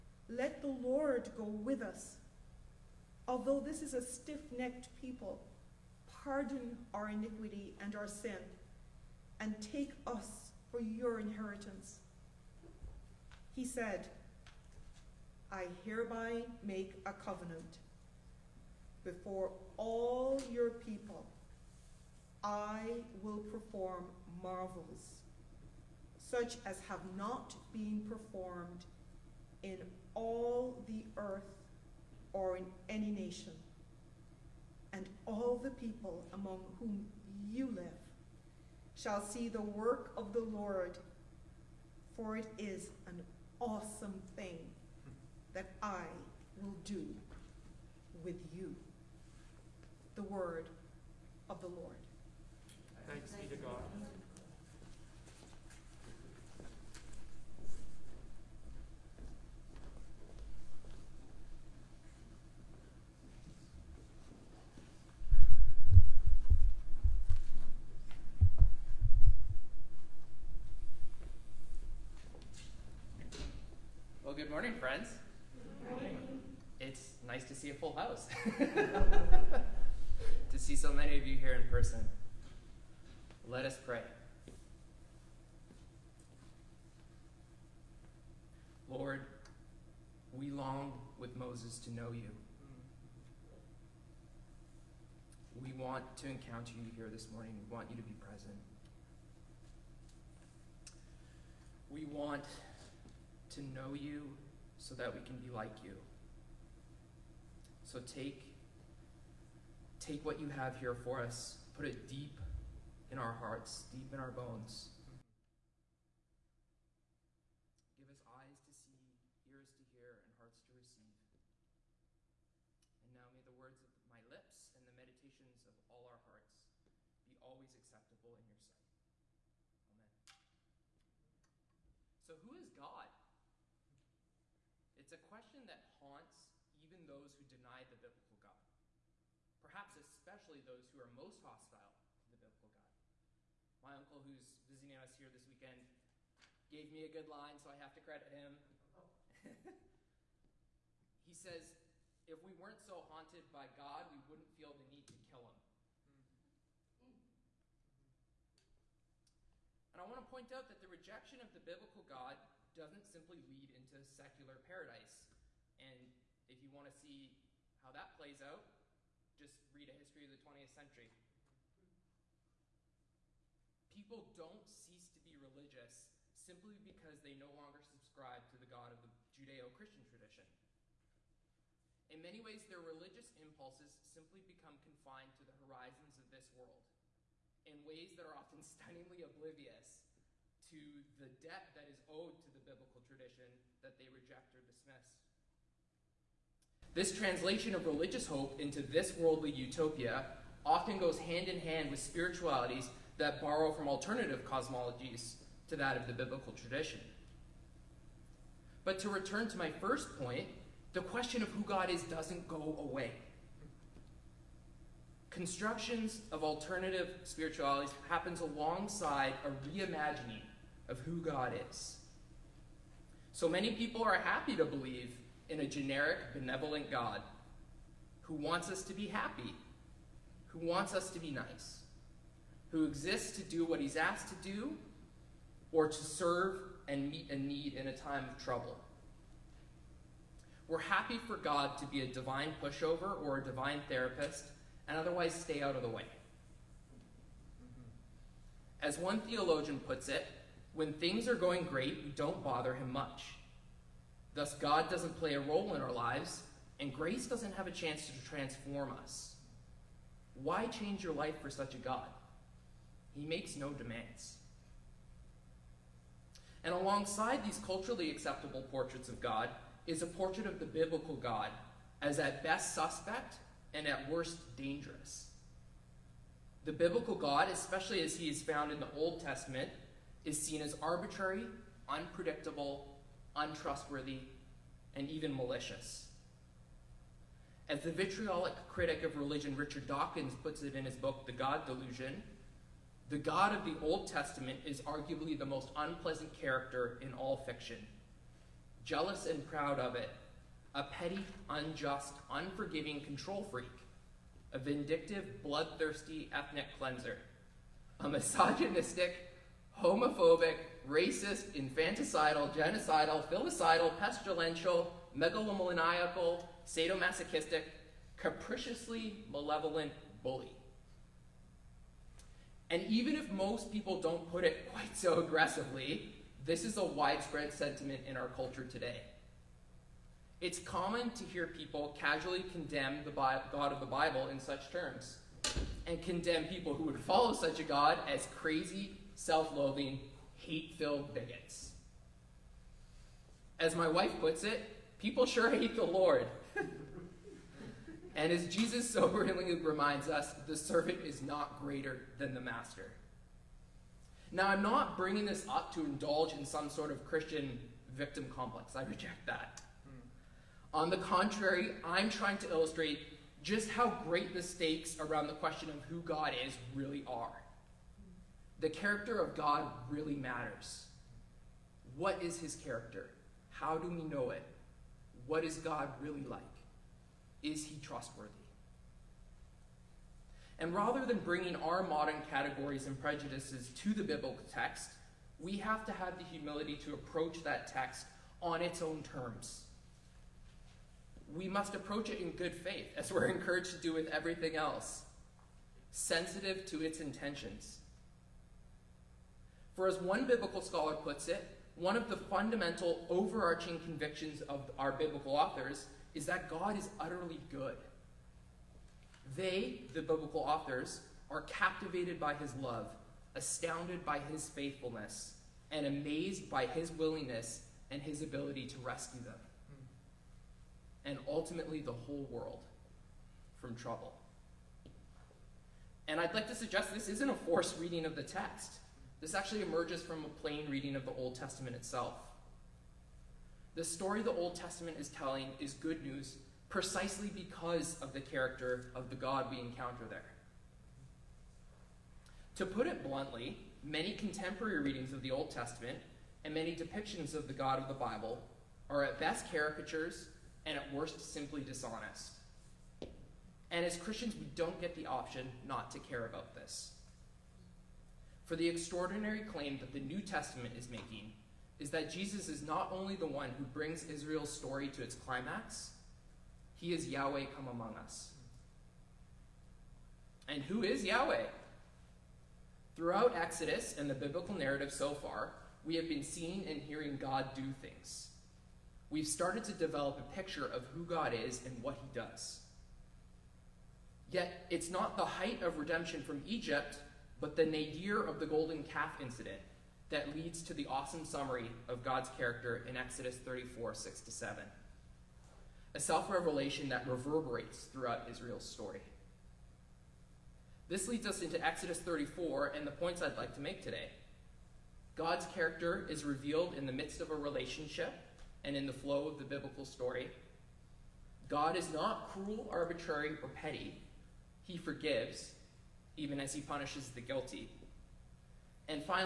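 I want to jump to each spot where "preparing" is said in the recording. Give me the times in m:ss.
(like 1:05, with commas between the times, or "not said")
not said.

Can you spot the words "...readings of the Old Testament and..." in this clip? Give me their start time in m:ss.
7:24.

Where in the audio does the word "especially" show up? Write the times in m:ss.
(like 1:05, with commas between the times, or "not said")
2:19, 4:37.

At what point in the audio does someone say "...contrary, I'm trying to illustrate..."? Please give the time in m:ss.
6:00.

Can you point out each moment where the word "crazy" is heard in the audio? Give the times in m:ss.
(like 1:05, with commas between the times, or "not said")
5:38.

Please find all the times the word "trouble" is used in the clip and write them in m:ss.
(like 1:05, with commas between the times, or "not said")
3:58, 7:03.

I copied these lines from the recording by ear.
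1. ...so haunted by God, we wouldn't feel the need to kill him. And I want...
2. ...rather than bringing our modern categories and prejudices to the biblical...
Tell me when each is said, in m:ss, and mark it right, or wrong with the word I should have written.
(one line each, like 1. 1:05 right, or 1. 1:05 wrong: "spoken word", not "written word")
1. 2:32 right
2. 6:20 right.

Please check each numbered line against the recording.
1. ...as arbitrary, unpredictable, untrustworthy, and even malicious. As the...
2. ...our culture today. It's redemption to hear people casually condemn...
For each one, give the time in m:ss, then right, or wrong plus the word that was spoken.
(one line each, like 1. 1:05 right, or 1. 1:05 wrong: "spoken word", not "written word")
1. 4:40 right
2. 5:28 wrong: "common", not "redemption".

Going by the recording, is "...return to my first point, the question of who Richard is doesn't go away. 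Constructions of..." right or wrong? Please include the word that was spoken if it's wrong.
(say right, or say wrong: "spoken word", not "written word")
wrong: "God", not "Richard".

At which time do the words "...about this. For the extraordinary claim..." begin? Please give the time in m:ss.
7:36.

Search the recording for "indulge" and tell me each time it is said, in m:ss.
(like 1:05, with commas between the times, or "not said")
5:55.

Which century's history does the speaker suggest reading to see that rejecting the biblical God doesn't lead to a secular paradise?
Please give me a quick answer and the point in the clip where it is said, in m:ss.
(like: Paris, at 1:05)
20th century, at 2:50.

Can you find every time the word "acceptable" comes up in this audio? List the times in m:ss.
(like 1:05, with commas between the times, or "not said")
2:07, 4:28.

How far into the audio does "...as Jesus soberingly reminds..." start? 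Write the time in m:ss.
5:48.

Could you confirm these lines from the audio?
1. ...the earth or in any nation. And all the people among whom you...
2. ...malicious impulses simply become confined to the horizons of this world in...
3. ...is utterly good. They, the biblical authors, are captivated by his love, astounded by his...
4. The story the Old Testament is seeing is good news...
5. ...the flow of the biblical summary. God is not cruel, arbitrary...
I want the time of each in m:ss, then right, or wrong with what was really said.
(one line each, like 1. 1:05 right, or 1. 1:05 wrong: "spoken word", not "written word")
1. 0:30 right
2. 3:02 wrong: "religious", not "malicious"
3. 6:46 right
4. 7:13 wrong: "telling", not "seeing"
5. 8:28 wrong: "story", not "summary".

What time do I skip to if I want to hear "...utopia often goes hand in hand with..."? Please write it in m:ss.
3:19.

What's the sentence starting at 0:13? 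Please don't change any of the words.
He said, I hereby make a covenant before all your people.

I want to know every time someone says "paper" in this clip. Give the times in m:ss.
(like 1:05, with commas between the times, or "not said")
not said.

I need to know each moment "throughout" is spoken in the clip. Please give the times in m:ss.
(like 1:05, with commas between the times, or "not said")
7:52, 8:17.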